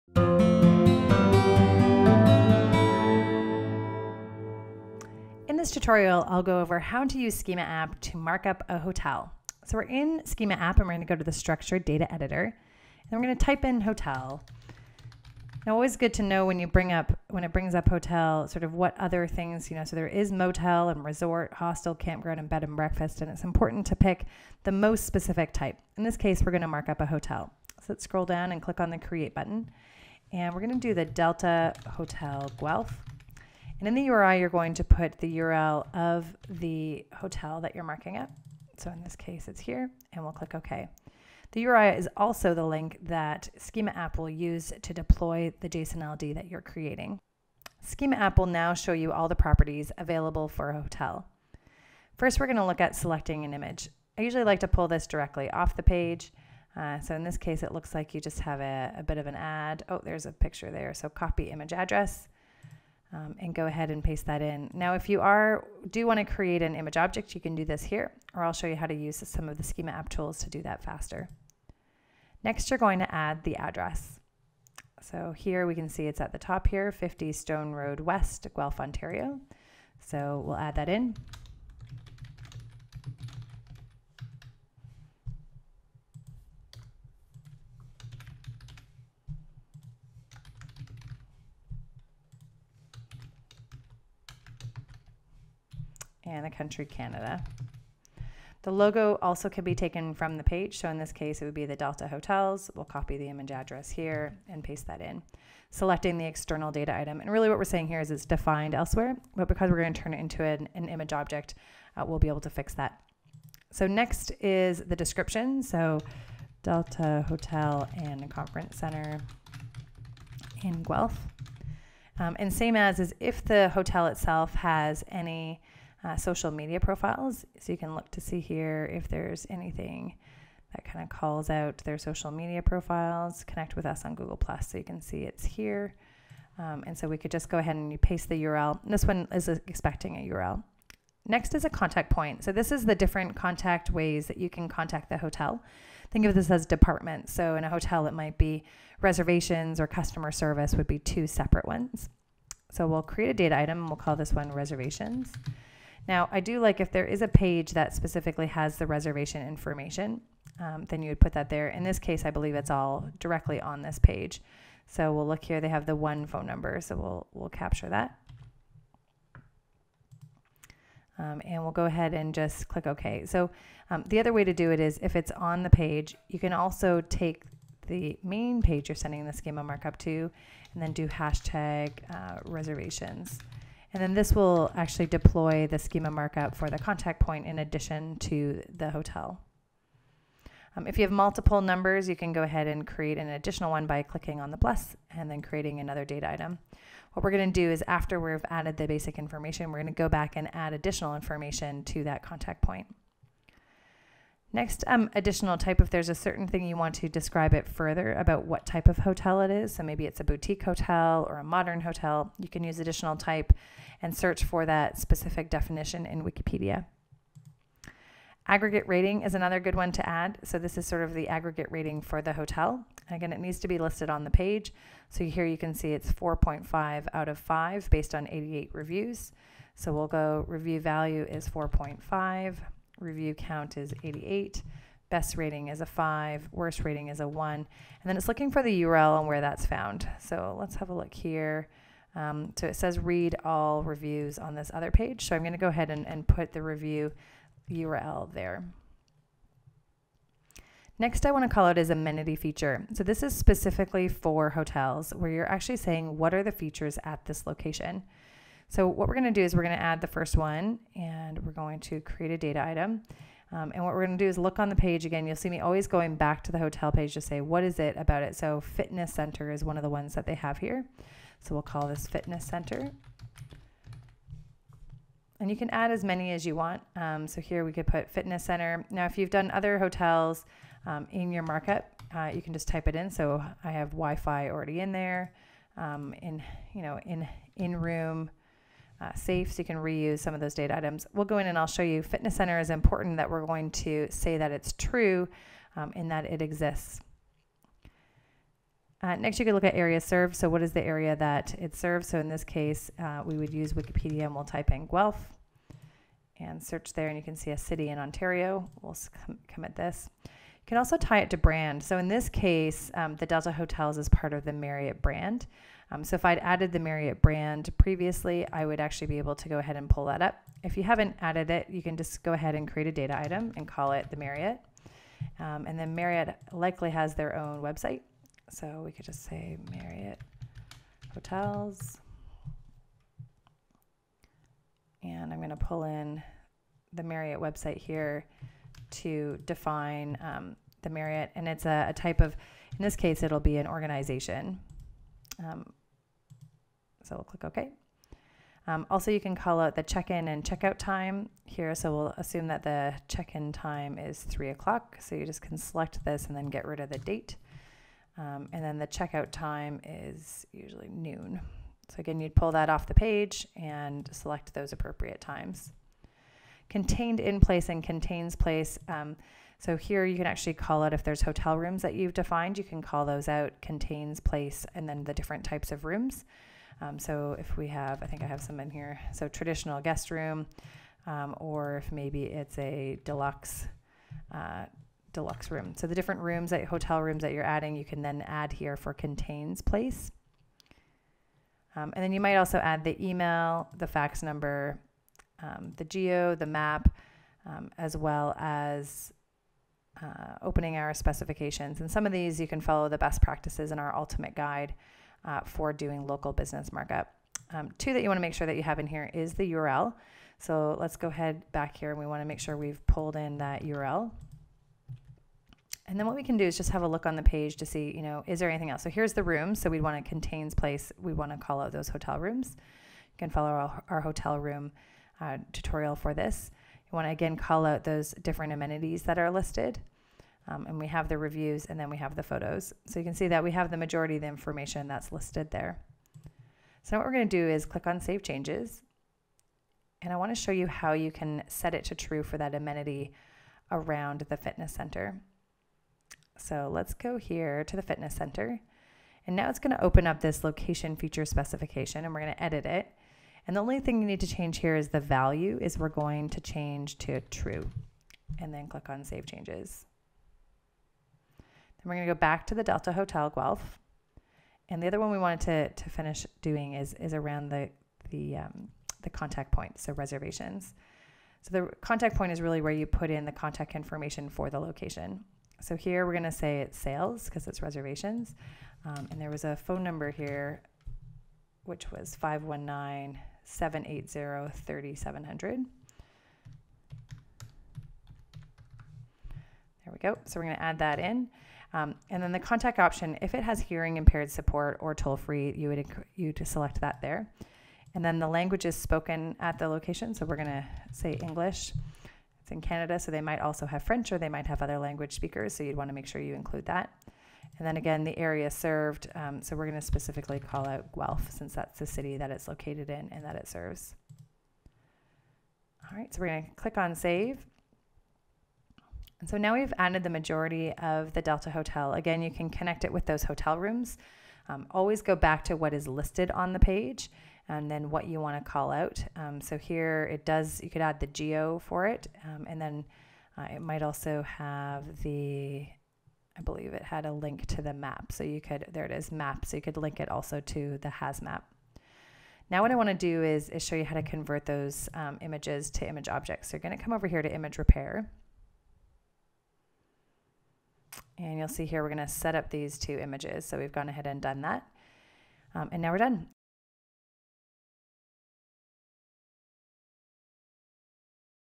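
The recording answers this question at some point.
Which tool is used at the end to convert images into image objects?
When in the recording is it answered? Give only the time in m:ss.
9:07.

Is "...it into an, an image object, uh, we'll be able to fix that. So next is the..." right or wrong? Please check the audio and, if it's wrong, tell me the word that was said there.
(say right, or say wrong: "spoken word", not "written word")
right.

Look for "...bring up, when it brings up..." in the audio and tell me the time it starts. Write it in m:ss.
0:16.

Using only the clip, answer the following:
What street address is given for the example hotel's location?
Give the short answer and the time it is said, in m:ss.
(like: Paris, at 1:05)
50 Stone Road West, at 1:16.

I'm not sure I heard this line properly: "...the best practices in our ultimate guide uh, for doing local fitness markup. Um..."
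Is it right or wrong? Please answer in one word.
wrong.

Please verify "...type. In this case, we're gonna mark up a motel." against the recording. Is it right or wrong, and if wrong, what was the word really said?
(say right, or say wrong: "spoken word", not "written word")
wrong: "hotel", not "motel".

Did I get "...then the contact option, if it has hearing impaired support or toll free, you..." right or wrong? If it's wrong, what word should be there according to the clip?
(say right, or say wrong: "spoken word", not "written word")
right.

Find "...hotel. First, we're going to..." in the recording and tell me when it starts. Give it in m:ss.
0:50.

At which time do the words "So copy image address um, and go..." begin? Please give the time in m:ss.
1:00.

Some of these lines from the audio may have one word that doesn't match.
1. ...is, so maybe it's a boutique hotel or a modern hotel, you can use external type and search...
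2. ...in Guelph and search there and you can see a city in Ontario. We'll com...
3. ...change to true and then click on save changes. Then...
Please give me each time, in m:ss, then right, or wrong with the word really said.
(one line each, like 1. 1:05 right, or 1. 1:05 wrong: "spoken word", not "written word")
1. 3:29 wrong: "additional", not "external"
2. 5:04 right
3. 7:36 right.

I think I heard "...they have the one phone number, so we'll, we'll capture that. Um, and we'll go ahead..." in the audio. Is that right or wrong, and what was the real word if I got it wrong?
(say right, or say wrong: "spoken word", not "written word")
right.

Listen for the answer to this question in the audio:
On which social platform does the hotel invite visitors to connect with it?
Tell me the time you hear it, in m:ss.
2:14.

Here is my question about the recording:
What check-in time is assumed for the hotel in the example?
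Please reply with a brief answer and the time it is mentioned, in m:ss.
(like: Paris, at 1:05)
3 o'clock, at 5:54.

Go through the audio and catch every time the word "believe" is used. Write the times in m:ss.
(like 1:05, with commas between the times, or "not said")
2:42, 8:56.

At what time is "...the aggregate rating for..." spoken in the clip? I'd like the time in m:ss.
3:41.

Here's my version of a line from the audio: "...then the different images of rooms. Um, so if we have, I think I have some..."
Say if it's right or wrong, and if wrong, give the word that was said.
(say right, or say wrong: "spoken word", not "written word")
wrong: "types", not "images".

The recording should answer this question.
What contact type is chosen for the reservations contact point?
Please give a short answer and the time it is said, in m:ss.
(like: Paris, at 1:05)
sales, at 7:56.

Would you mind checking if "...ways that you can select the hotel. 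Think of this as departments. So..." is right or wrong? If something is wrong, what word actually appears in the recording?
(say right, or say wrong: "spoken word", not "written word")
wrong: "contact", not "select".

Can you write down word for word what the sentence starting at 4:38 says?
Now if you've done other hotels um, in your markup, uh, you can just type it in.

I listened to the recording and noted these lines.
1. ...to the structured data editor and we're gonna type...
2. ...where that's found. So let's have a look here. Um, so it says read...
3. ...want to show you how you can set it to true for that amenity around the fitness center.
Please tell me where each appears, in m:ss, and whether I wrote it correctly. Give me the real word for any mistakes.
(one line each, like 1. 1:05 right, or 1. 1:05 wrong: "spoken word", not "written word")
1. 0:11 right
2. 3:59 right
3. 7:20 right.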